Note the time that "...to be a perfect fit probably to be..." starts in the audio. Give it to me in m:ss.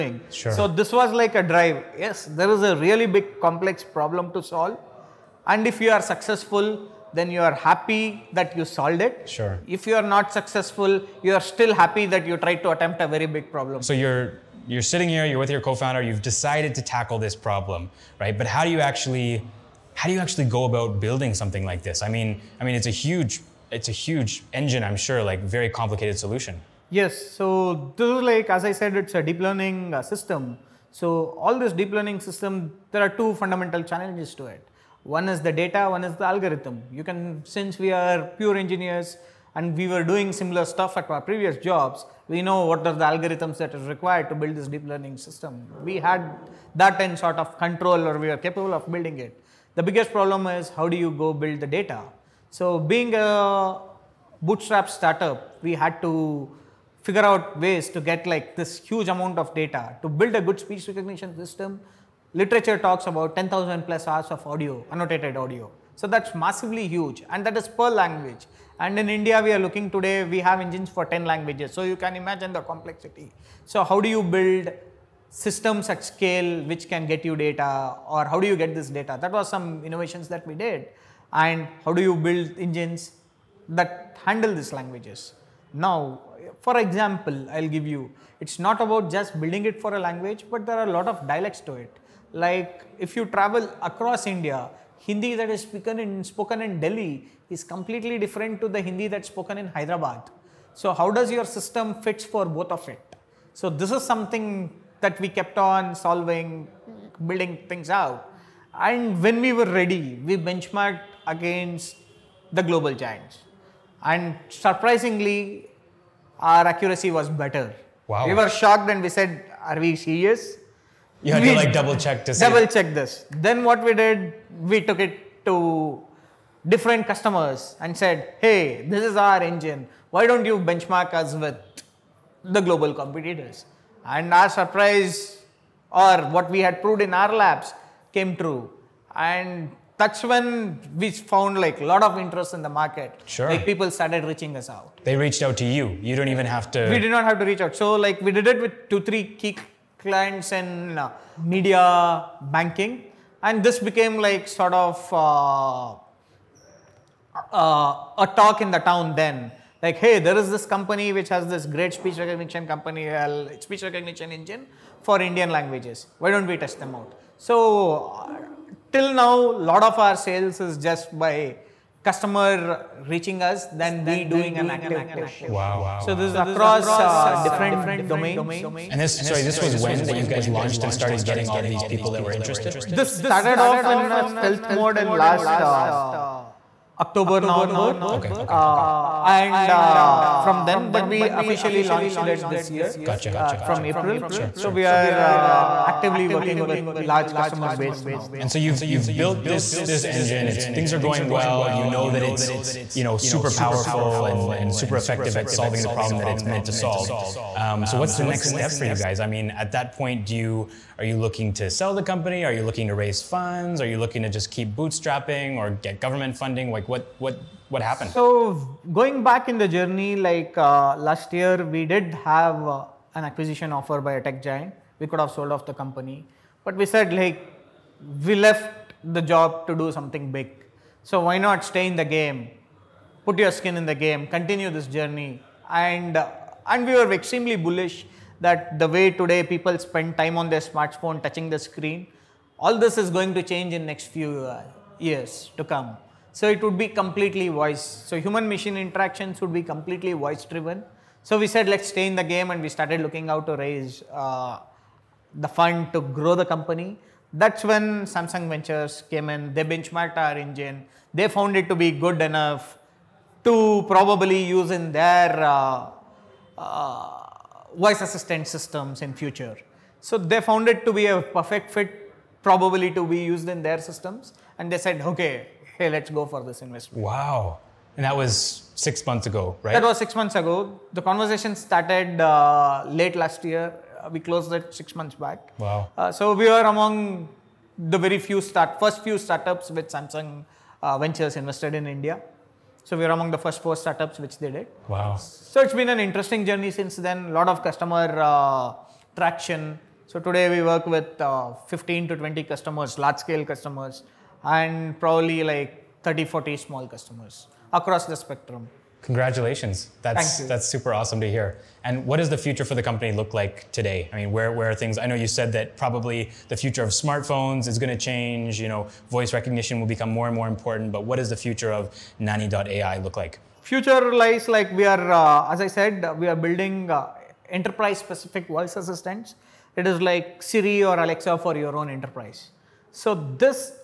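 4:30.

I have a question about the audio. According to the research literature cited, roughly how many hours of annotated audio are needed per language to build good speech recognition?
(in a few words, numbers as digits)
10,000 plus hours.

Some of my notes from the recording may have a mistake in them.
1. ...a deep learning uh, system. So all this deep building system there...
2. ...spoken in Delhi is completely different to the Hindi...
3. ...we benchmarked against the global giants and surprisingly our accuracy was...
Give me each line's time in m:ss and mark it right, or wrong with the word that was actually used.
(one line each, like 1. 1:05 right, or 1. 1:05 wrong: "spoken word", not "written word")
1. 0:29 wrong: "learning", not "building"
2. 1:36 right
3. 1:50 right.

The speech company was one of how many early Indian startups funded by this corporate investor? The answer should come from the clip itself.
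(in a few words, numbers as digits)
4.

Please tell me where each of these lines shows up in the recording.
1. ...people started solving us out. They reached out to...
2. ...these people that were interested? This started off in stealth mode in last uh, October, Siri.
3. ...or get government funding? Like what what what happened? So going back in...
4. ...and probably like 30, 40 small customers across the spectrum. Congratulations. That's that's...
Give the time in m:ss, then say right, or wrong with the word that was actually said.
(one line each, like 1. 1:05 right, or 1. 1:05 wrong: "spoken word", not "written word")
1. 2:23 wrong: "reaching", not "solving"
2. 3:01 wrong: "November", not "Siri"
3. 3:35 right
4. 5:04 right.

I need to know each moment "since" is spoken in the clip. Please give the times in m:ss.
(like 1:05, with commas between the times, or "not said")
0:37, 4:56.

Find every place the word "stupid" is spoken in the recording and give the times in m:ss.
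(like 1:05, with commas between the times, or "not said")
not said.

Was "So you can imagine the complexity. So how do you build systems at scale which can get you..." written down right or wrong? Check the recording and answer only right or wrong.
right.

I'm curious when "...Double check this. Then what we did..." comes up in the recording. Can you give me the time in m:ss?
2:02.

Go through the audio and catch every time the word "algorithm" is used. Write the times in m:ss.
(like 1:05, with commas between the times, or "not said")
0:36, 0:43.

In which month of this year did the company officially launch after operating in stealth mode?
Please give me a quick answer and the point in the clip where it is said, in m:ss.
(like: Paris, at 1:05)
April, at 3:13.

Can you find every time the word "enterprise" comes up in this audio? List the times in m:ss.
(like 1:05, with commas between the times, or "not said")
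5:27, 5:31.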